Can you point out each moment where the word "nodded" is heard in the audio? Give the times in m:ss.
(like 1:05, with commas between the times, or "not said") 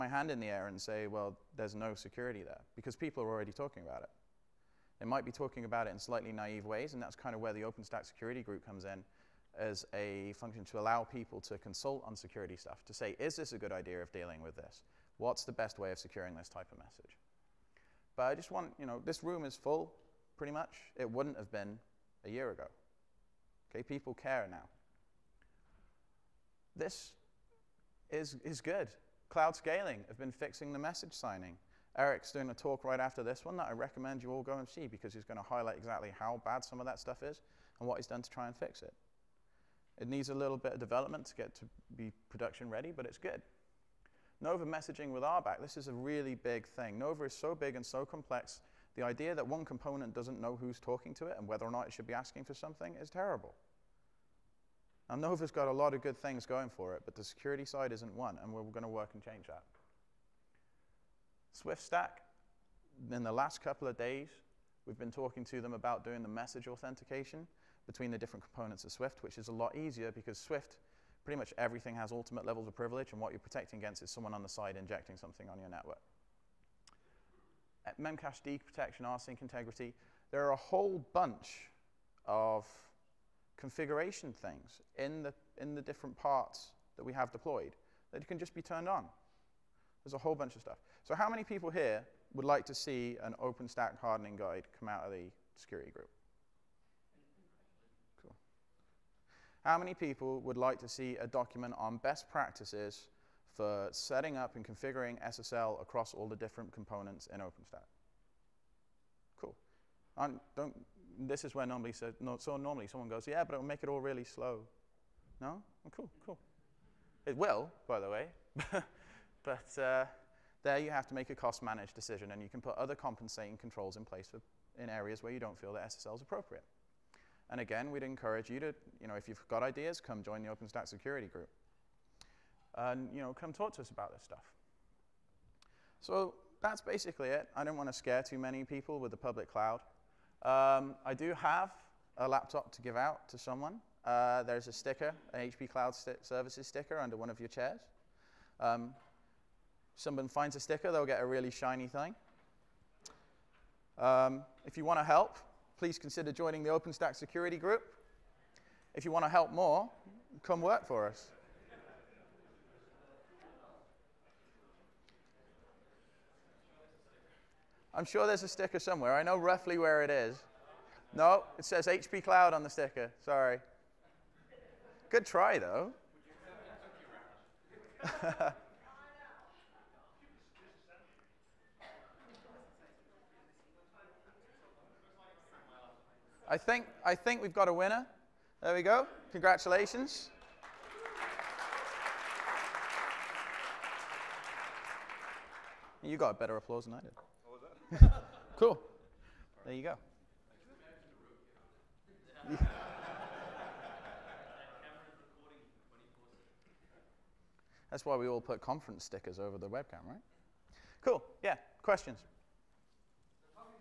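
not said.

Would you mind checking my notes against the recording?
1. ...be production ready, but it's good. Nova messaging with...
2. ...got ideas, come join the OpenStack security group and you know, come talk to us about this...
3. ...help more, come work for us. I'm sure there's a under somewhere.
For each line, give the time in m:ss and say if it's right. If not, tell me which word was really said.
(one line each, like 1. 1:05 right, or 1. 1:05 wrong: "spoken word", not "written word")
1. 0:41 right
2. 2:09 right
3. 2:39 wrong: "sticker", not "under".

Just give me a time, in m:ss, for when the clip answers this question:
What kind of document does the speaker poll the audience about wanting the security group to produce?
1:33.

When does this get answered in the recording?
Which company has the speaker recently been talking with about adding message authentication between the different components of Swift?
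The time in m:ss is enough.
1:01.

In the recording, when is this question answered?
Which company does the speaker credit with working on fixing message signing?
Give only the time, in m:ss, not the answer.
0:29.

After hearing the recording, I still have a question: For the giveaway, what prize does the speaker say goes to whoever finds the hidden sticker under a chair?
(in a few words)
a laptop.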